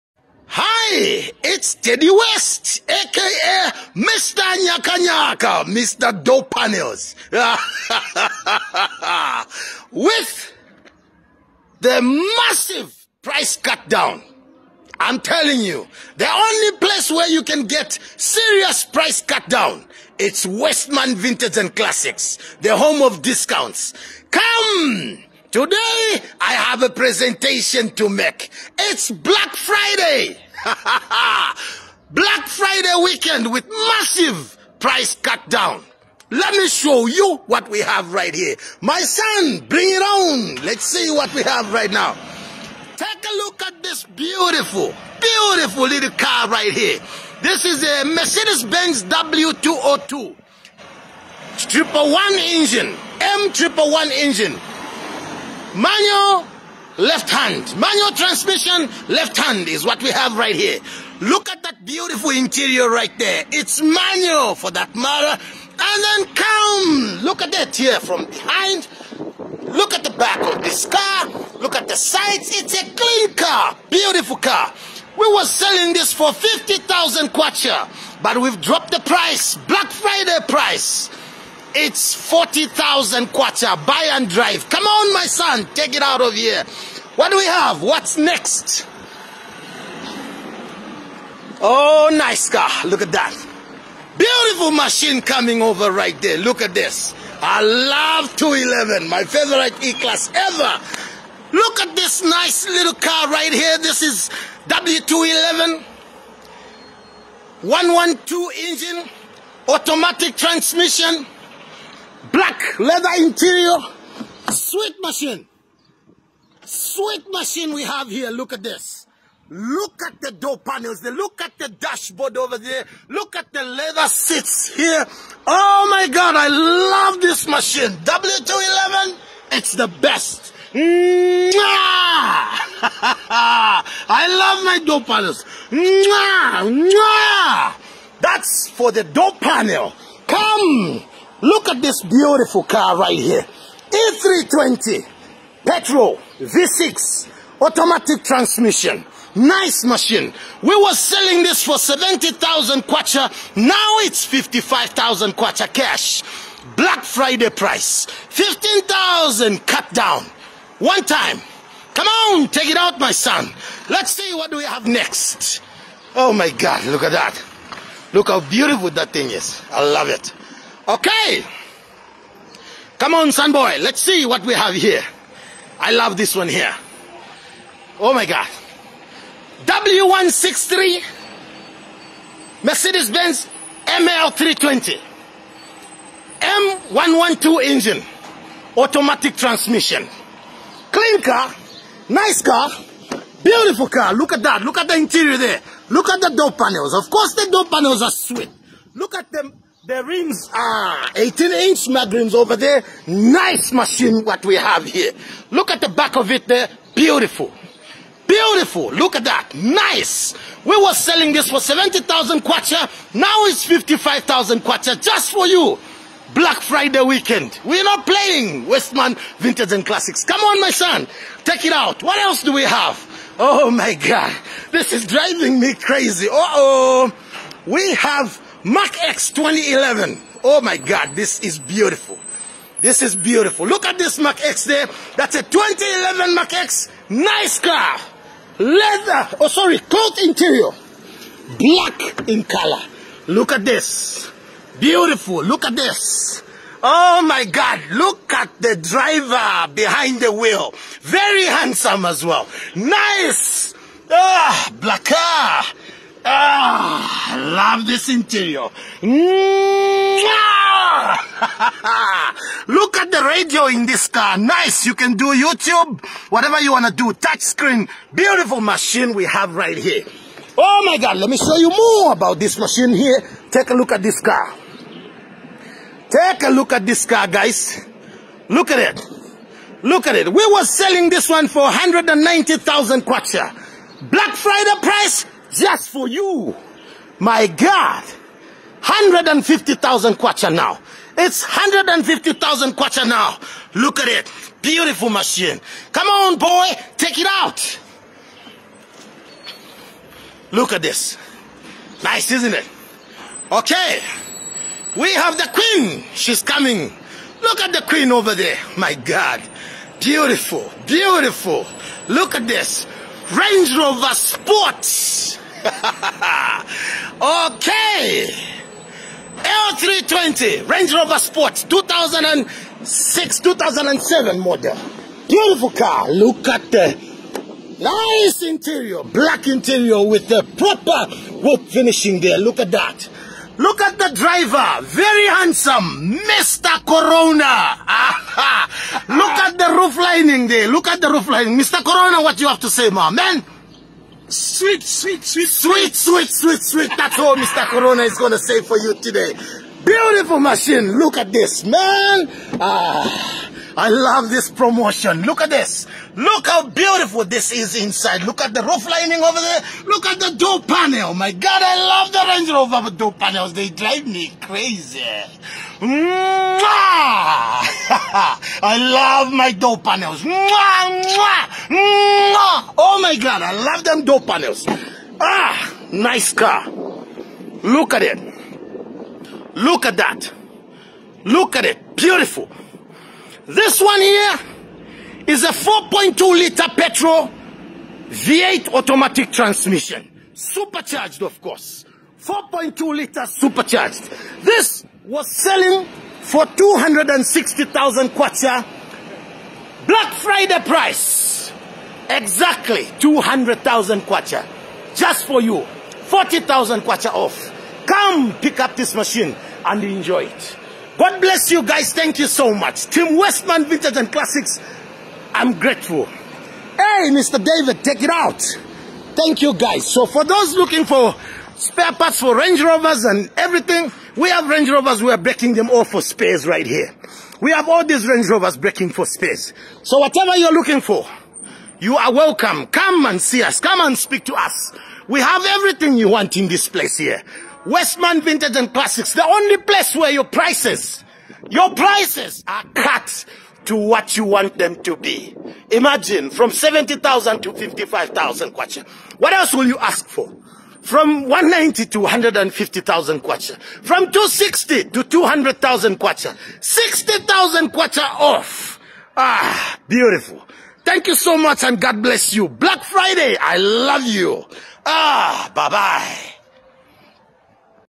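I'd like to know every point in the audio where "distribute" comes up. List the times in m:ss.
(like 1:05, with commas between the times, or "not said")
not said.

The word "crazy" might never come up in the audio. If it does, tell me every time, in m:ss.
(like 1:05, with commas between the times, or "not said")
3:45, 6:04.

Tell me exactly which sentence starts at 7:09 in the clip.
So whatever you're looking for, you are welcome.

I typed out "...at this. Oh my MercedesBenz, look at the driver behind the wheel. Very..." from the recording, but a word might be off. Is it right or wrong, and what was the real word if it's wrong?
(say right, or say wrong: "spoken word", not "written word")
wrong: "God", not "MercedesBenz".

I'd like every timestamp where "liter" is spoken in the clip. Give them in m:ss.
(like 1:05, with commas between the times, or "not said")
6:26, 6:32.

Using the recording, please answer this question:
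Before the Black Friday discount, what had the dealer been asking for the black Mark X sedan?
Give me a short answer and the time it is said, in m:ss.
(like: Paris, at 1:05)
190,000 kwacha, at 4:41.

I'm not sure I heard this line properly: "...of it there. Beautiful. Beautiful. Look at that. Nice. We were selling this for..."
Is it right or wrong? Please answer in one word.
right.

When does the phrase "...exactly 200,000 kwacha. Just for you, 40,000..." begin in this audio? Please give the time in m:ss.
6:42.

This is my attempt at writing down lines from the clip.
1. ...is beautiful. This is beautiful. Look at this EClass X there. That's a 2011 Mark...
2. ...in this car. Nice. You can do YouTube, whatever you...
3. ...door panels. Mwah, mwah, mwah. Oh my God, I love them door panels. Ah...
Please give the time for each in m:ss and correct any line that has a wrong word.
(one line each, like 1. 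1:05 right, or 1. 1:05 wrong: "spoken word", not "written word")
1. 3:51 wrong: "Mark", not "EClass"
2. 4:23 right
3. 6:09 right.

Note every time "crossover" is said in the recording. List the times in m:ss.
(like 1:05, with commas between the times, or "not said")
not said.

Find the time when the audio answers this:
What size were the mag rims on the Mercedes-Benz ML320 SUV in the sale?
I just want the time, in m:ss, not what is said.
3:21.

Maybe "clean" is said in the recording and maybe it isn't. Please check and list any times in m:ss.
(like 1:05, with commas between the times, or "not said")
1:12, 3:10.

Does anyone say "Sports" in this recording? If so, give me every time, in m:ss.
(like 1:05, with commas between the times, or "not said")
5:14, 5:21.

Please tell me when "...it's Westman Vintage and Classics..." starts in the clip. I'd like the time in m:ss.
0:20.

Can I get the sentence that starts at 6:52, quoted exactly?
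Team Westman Vintage and Classics, I'm grateful.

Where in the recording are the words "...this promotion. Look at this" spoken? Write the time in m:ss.
5:54.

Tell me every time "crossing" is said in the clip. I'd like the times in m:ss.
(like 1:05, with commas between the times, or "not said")
not said.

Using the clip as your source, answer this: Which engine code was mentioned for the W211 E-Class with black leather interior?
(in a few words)
112.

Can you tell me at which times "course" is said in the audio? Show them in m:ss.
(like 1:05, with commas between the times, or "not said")
3:17, 6:31.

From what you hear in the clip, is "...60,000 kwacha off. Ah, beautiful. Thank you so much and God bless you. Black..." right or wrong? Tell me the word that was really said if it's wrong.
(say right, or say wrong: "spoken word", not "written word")
right.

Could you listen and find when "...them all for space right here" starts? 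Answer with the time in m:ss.
7:05.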